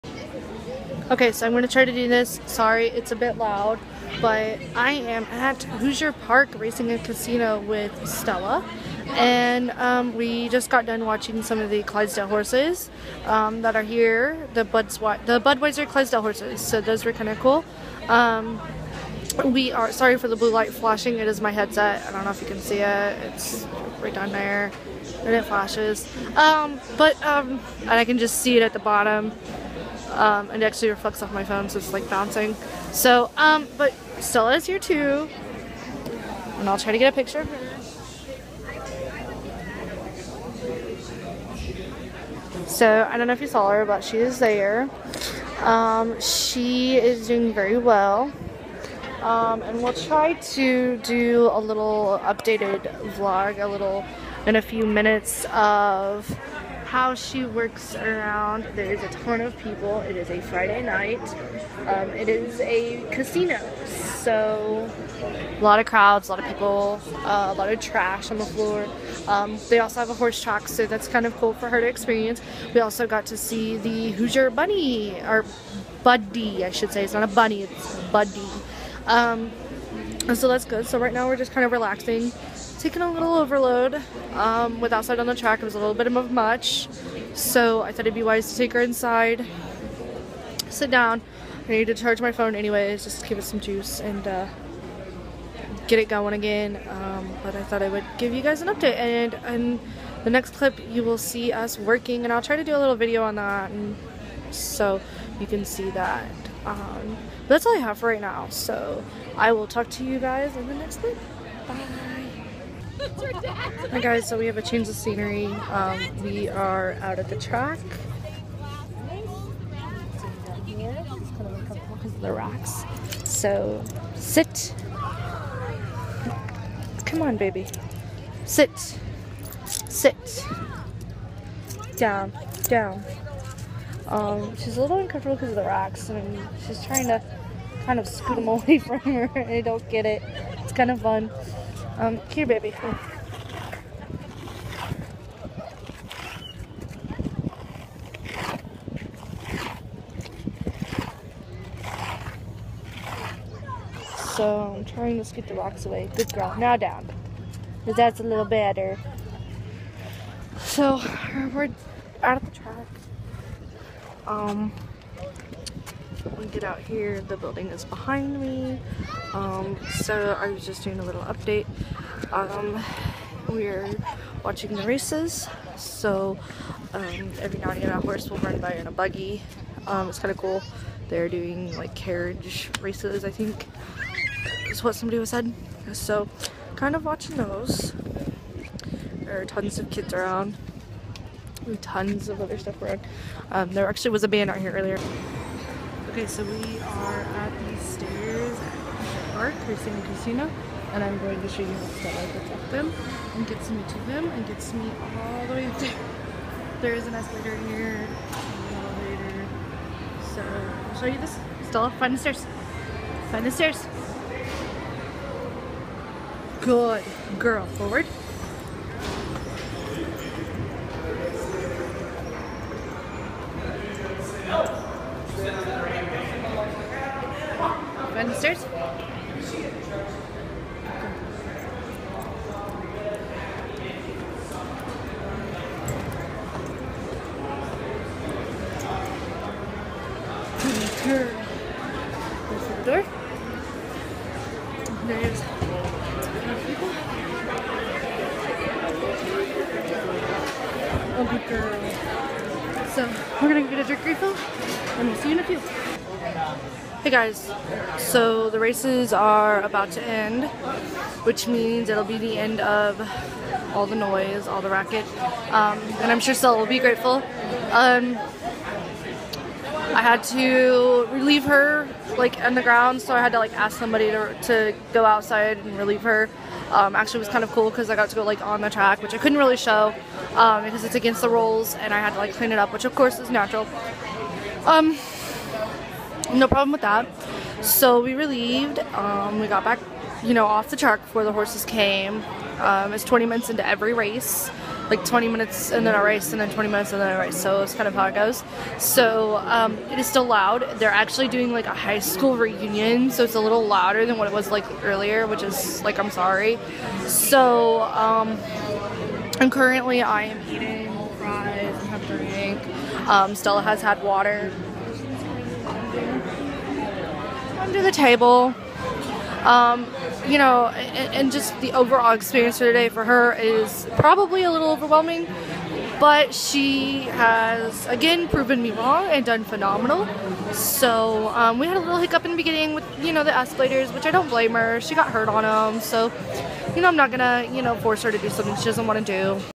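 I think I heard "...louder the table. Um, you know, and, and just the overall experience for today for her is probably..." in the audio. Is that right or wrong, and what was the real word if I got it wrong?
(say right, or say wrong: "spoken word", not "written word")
wrong: "under", not "louder".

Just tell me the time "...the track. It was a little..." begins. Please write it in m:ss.
1:25.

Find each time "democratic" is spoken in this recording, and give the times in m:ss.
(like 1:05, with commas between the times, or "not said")
not said.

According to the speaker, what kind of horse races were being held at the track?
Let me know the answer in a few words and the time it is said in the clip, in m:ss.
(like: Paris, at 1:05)
carriage races, at 3:01.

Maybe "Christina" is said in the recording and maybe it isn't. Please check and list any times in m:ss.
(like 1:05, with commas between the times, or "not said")
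3:19.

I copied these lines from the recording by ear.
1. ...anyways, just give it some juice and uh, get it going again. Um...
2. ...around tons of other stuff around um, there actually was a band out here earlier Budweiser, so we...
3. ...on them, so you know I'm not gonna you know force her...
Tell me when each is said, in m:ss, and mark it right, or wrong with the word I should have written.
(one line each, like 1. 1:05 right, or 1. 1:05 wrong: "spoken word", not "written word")
1. 1:32 right
2. 3:10 wrong: "Okay", not "Budweiser"
3. 5:35 right.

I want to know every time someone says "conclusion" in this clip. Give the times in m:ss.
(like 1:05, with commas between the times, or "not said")
not said.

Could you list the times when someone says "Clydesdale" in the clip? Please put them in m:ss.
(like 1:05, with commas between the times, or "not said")
0:11, 0:15.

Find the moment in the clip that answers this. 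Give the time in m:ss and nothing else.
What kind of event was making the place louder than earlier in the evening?
5:01.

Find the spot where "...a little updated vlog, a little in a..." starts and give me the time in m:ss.
0:51.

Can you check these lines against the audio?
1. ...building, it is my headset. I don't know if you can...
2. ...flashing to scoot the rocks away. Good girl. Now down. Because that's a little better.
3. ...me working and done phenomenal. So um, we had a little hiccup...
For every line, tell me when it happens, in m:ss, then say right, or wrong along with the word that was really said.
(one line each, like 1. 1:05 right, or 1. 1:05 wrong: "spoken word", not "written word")
1. 0:20 wrong: "flashing", not "building"
2. 2:34 wrong: "trying", not "flashing"
3. 5:28 wrong: "wrong", not "working".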